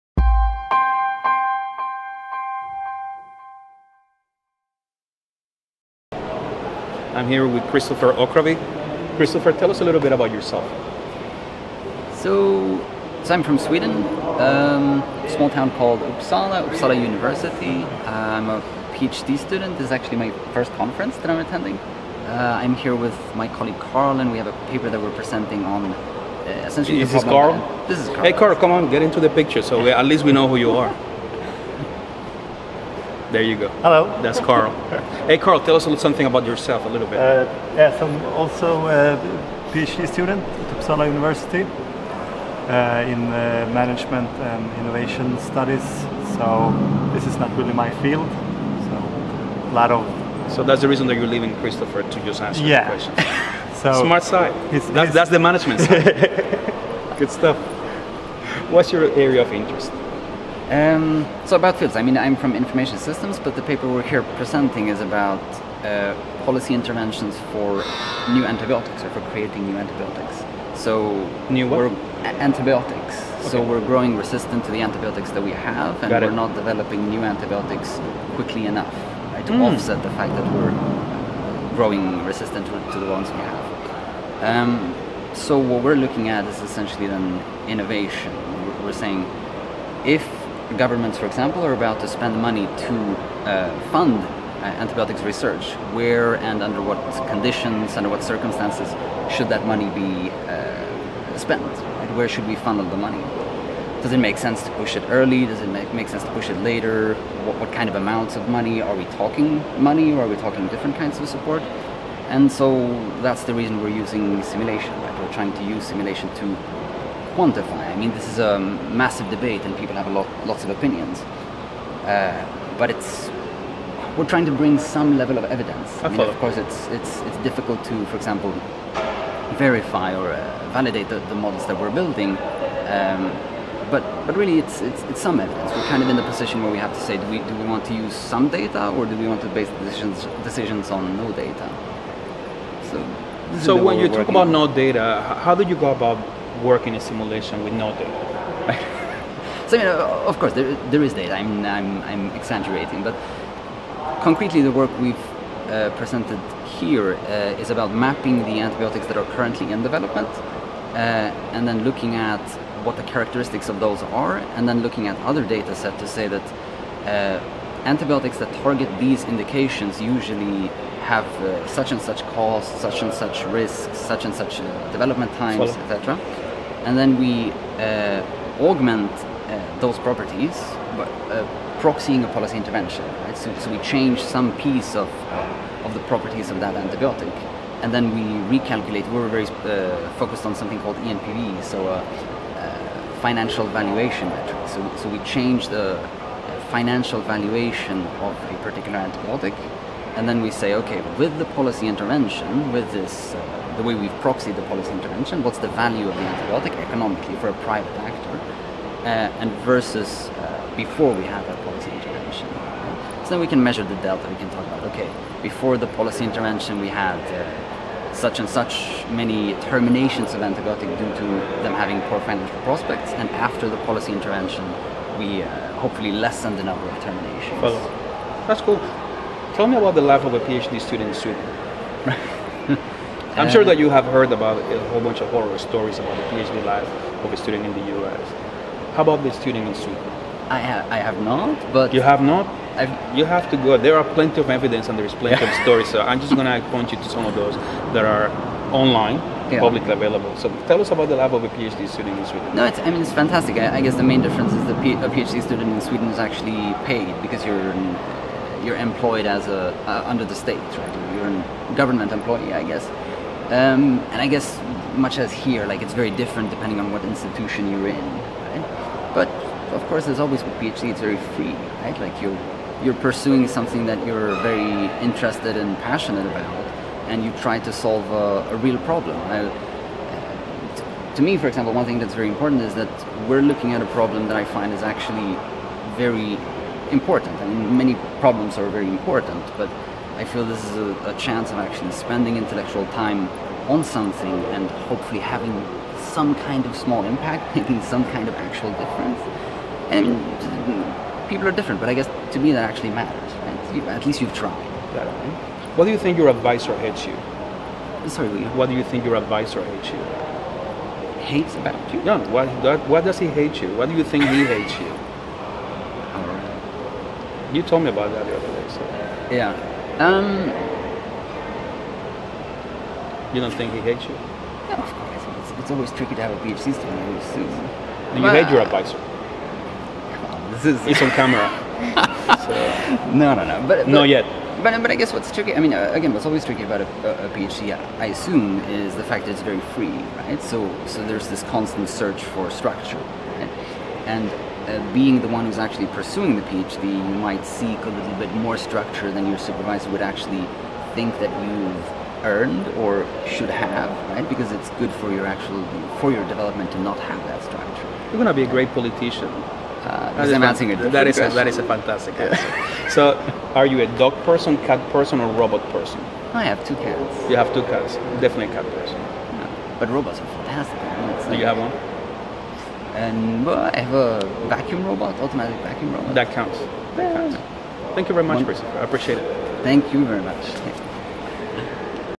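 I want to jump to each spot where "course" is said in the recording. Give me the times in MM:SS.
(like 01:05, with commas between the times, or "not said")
02:06, 02:30, 04:29, 05:24.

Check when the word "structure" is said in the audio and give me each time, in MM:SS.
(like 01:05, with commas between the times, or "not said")
05:42, 05:48, 05:57.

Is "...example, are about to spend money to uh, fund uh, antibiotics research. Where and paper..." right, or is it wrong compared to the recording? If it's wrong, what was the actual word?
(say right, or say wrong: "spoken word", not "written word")
wrong: "under", not "paper".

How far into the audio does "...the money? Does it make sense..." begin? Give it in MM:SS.
01:42.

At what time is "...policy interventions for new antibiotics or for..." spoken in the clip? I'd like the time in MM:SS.
01:06.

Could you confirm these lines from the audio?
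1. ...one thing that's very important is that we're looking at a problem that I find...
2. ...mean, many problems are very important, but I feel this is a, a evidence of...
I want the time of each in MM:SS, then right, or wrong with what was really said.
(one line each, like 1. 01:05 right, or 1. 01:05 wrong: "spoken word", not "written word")
1. 04:41 right
2. 04:47 wrong: "chance", not "evidence".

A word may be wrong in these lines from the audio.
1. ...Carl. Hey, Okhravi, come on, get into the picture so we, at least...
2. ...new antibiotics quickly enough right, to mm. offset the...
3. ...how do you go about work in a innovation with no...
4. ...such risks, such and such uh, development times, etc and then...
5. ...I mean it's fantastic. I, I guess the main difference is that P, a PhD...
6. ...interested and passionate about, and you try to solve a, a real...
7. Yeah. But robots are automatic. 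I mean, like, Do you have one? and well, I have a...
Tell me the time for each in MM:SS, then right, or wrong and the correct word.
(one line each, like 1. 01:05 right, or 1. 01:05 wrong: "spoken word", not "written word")
1. 00:28 wrong: "Carl", not "Okhravi"
2. 01:17 right
3. 02:25 wrong: "simulation", not "innovation"
4. 02:53 right
5. 04:12 right
6. 04:35 right
7. 06:08 wrong: "fantastic", not "automatic".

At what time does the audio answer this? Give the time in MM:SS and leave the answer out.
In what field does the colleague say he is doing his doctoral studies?
00:43.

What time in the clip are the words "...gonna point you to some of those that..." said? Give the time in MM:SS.
04:06.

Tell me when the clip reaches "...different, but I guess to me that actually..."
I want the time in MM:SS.
05:01.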